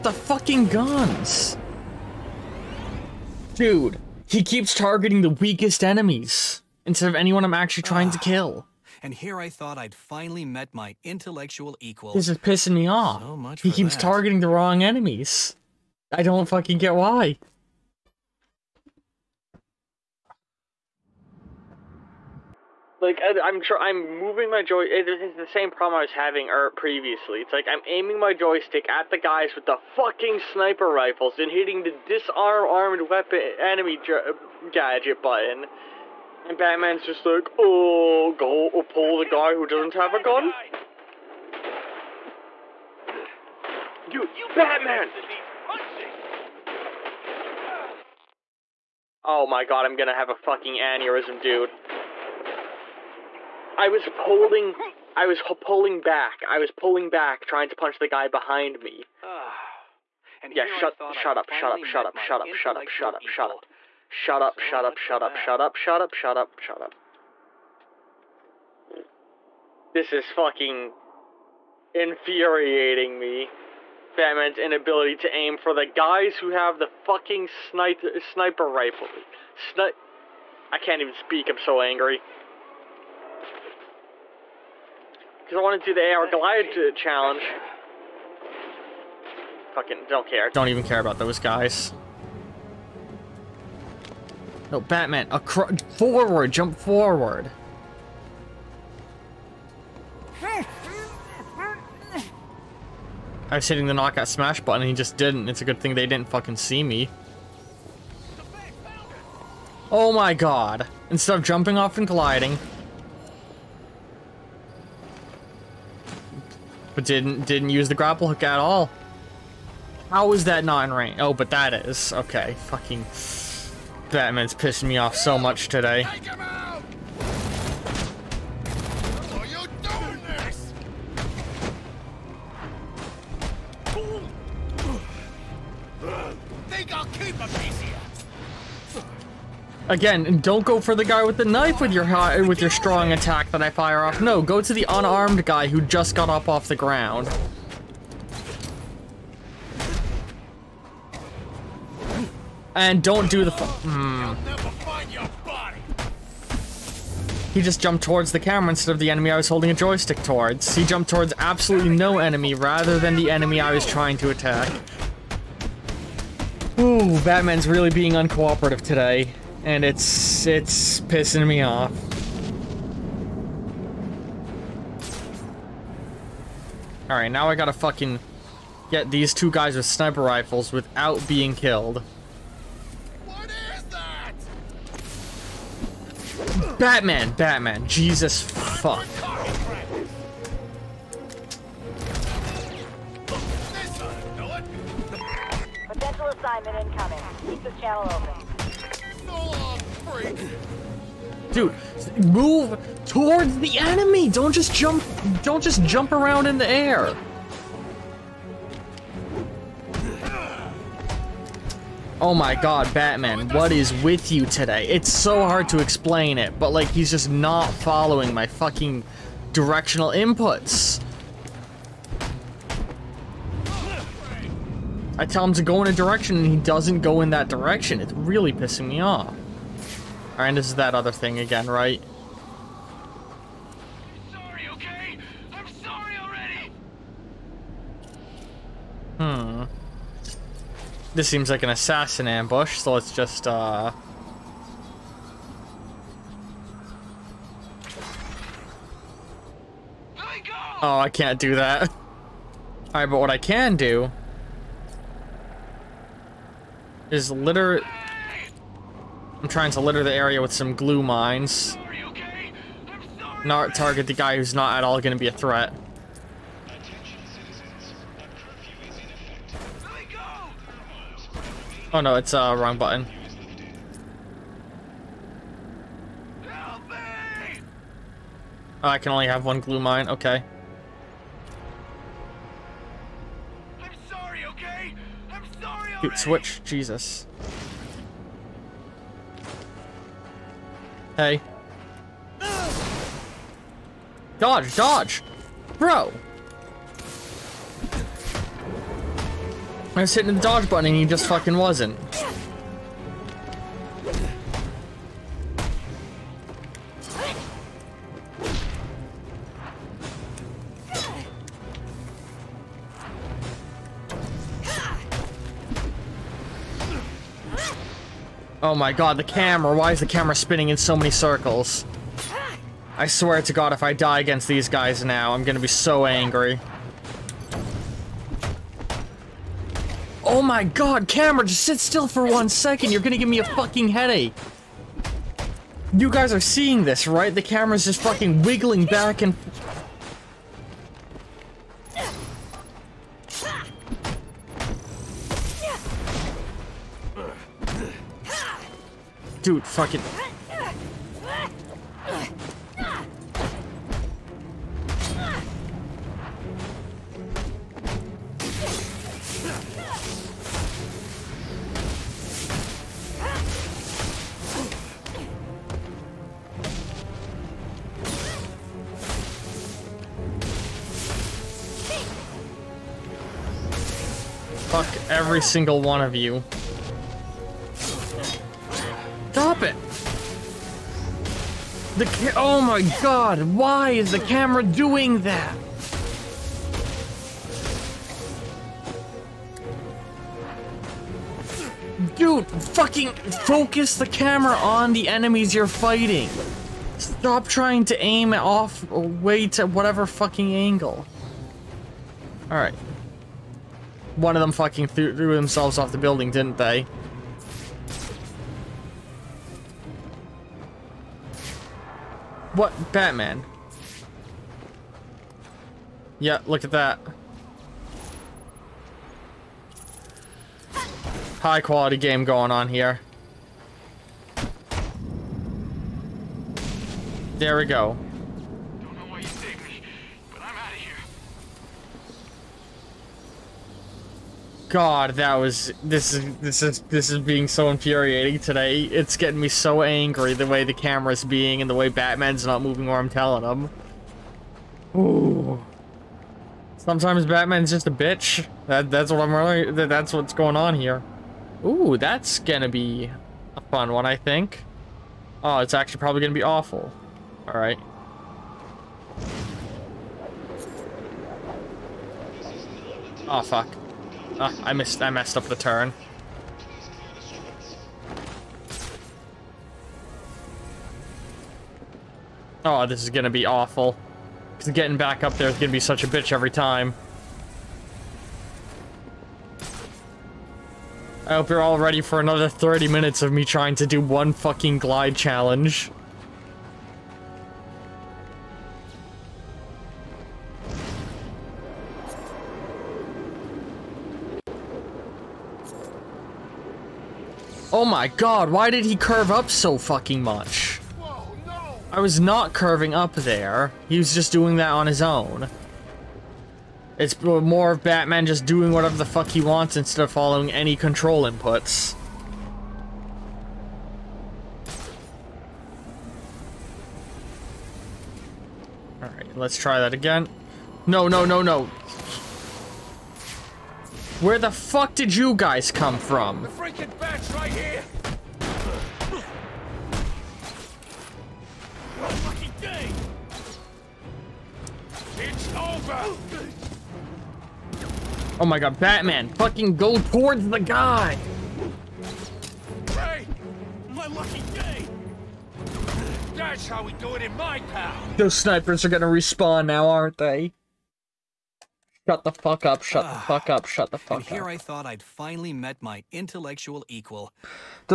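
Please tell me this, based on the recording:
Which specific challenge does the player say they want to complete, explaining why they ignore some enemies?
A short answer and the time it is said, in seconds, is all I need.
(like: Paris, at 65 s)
AR Glide challenge, at 86 s.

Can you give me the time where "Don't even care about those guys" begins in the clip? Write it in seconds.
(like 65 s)
90 s.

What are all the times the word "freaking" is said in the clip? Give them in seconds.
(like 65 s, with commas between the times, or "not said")
526 s.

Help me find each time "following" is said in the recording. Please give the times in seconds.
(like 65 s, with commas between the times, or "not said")
217 s, 510 s.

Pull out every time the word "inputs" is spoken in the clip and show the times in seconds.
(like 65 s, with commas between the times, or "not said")
220 s, 511 s.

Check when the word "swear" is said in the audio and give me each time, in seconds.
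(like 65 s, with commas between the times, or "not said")
323 s.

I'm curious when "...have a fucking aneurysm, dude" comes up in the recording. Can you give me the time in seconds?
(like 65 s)
50 s.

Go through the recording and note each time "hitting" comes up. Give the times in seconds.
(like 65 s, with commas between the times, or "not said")
31 s, 103 s, 300 s.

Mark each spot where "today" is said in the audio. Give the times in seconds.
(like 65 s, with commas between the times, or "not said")
125 s, 168 s, 214 s, 438 s.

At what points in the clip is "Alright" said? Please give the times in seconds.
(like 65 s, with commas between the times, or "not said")
177 s, 230 s, 252 s, 402 s, 519 s.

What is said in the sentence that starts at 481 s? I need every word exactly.
I hope you're all ready for another 30 minutes of me trying to do one fucking glide challenge.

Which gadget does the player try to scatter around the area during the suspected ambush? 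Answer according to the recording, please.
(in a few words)
Glue mines.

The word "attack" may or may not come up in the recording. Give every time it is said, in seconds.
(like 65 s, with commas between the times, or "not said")
143 s, 164 s.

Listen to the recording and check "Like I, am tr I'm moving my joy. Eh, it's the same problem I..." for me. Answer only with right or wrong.
right.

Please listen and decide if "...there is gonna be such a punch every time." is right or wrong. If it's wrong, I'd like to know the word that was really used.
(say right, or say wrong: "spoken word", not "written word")
wrong: "bitch", not "punch".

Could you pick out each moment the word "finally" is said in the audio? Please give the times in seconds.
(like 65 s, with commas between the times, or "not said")
9 s, 555 s.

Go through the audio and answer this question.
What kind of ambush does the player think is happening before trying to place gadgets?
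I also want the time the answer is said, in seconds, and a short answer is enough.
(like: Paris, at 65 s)
Assassin ambush, at 241 s.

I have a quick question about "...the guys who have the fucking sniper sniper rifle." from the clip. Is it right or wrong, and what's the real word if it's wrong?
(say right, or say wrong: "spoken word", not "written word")
right.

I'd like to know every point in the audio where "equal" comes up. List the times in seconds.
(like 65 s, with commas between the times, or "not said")
11 s, 556 s.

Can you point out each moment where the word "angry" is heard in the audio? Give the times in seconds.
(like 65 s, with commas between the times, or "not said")
81 s, 326 s, 439 s.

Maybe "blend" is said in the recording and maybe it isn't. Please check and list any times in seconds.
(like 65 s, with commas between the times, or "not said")
not said.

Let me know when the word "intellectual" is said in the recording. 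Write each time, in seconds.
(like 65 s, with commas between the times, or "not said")
11 s, 556 s.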